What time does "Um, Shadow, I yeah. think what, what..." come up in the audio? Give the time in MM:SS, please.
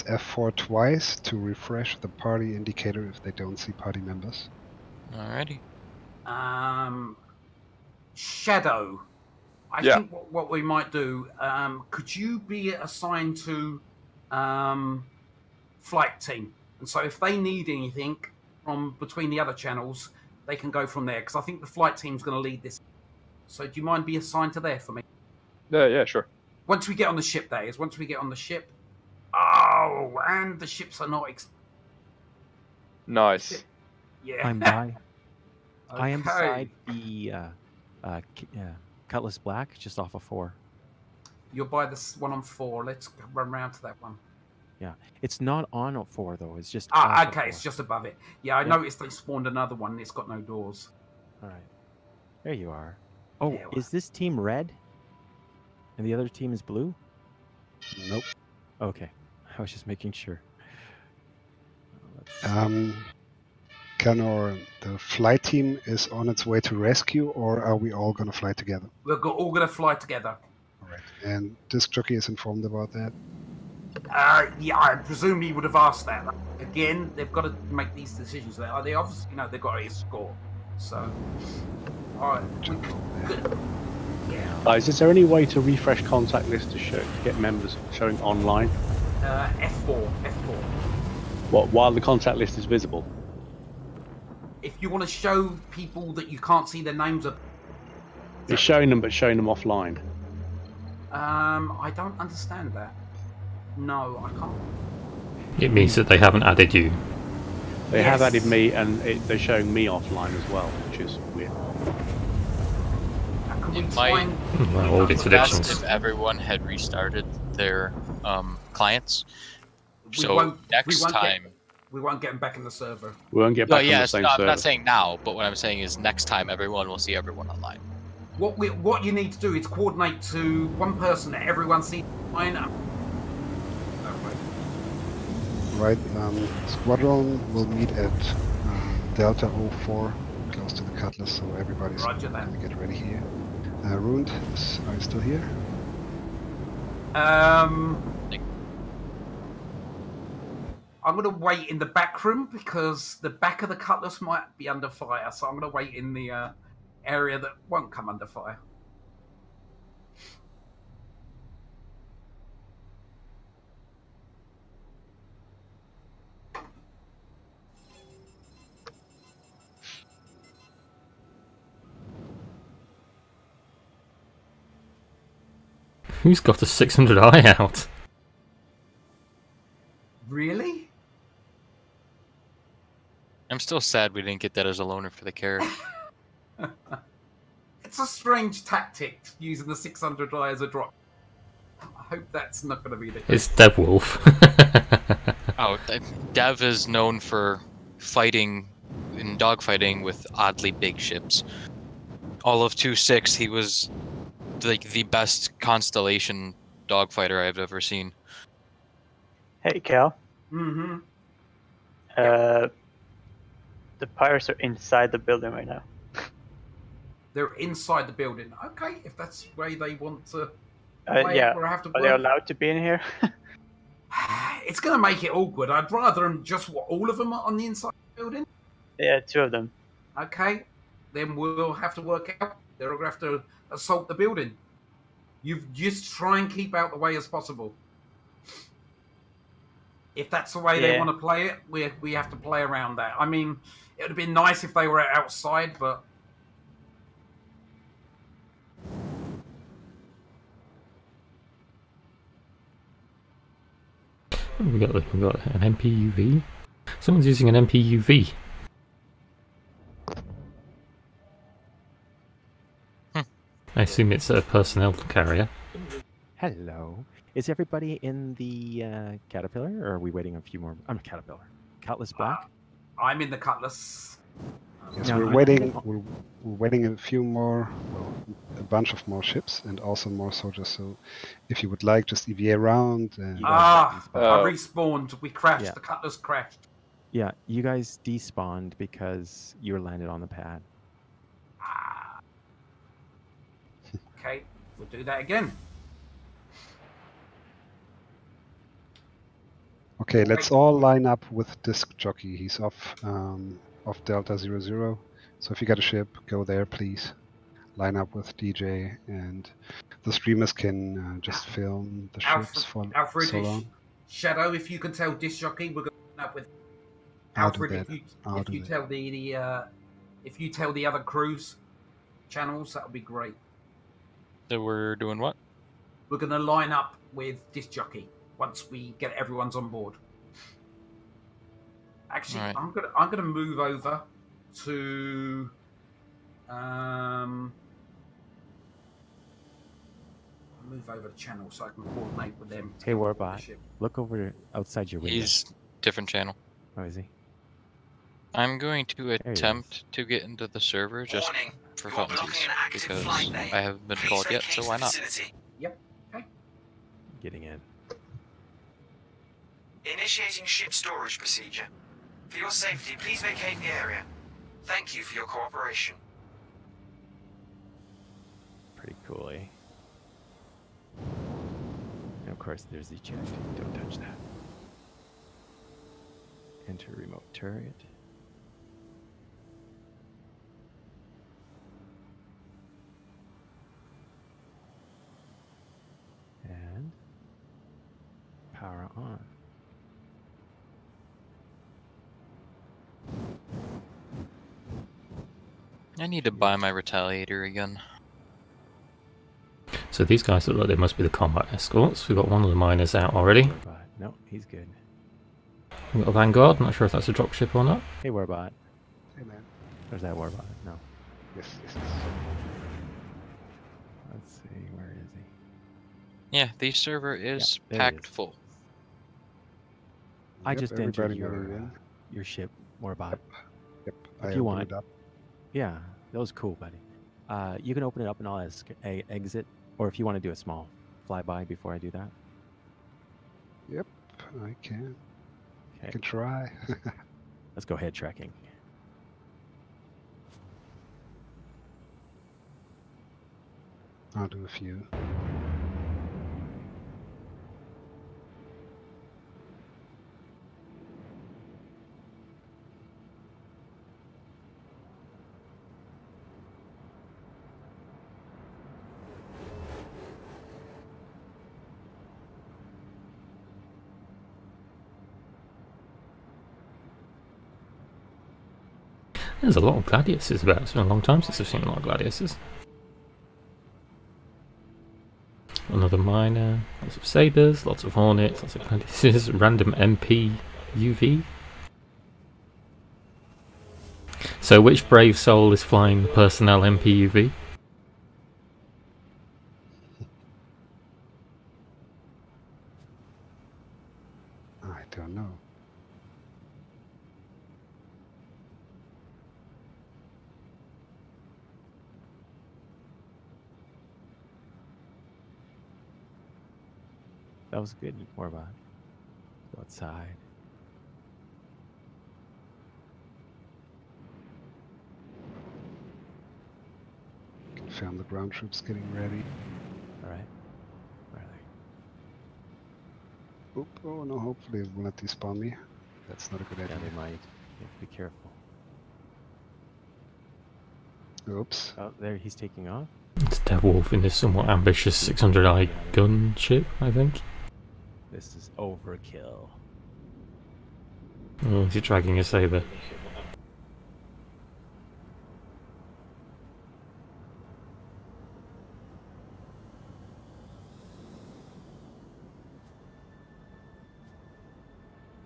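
00:06.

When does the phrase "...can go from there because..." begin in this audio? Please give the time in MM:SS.
00:20.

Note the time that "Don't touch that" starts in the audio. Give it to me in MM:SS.
06:13.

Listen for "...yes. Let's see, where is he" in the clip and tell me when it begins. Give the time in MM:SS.
06:51.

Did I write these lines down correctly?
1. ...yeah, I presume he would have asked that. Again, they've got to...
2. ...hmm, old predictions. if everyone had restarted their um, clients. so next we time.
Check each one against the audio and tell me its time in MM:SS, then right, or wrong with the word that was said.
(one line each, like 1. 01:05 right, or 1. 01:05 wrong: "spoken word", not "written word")
1. 01:14 right
2. 01:54 right.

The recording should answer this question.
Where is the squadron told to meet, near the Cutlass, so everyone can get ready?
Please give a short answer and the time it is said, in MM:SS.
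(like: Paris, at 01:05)
Delta 04, at 02:19.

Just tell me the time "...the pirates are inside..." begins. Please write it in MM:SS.
03:33.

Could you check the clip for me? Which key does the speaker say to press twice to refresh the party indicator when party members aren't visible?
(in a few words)
F4.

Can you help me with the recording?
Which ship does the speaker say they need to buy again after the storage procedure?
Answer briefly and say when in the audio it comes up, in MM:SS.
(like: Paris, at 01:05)
Retaliator, at 06:36.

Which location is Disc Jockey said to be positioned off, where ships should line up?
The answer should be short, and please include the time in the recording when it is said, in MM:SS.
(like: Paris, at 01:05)
Delta 00, at 05:04.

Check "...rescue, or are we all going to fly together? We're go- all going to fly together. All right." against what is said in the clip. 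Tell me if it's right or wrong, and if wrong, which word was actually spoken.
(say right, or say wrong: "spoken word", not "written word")
right.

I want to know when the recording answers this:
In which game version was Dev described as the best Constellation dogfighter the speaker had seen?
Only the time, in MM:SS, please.
03:22.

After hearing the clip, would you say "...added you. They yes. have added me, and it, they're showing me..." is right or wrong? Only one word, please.
right.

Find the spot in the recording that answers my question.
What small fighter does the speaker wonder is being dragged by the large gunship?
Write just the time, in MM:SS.
09:02.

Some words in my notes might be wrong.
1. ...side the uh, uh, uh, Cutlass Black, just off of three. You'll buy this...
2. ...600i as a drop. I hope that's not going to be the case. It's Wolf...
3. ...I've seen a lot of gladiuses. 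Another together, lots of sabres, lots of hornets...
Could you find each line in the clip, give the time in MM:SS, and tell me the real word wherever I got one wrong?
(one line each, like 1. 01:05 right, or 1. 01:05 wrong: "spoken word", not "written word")
1. 00:36 wrong: "four", not "three"
2. 03:09 wrong: "Dev", not "Wolf"
3. 07:51 wrong: "miner", not "together".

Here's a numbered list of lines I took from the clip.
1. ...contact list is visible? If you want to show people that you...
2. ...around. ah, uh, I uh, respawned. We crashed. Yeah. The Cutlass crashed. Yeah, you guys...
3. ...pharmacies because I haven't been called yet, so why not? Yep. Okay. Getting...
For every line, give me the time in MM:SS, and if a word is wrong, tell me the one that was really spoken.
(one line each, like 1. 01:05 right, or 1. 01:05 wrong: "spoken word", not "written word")
1. 01:32 right
2. 04:42 right
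3. 05:51 right.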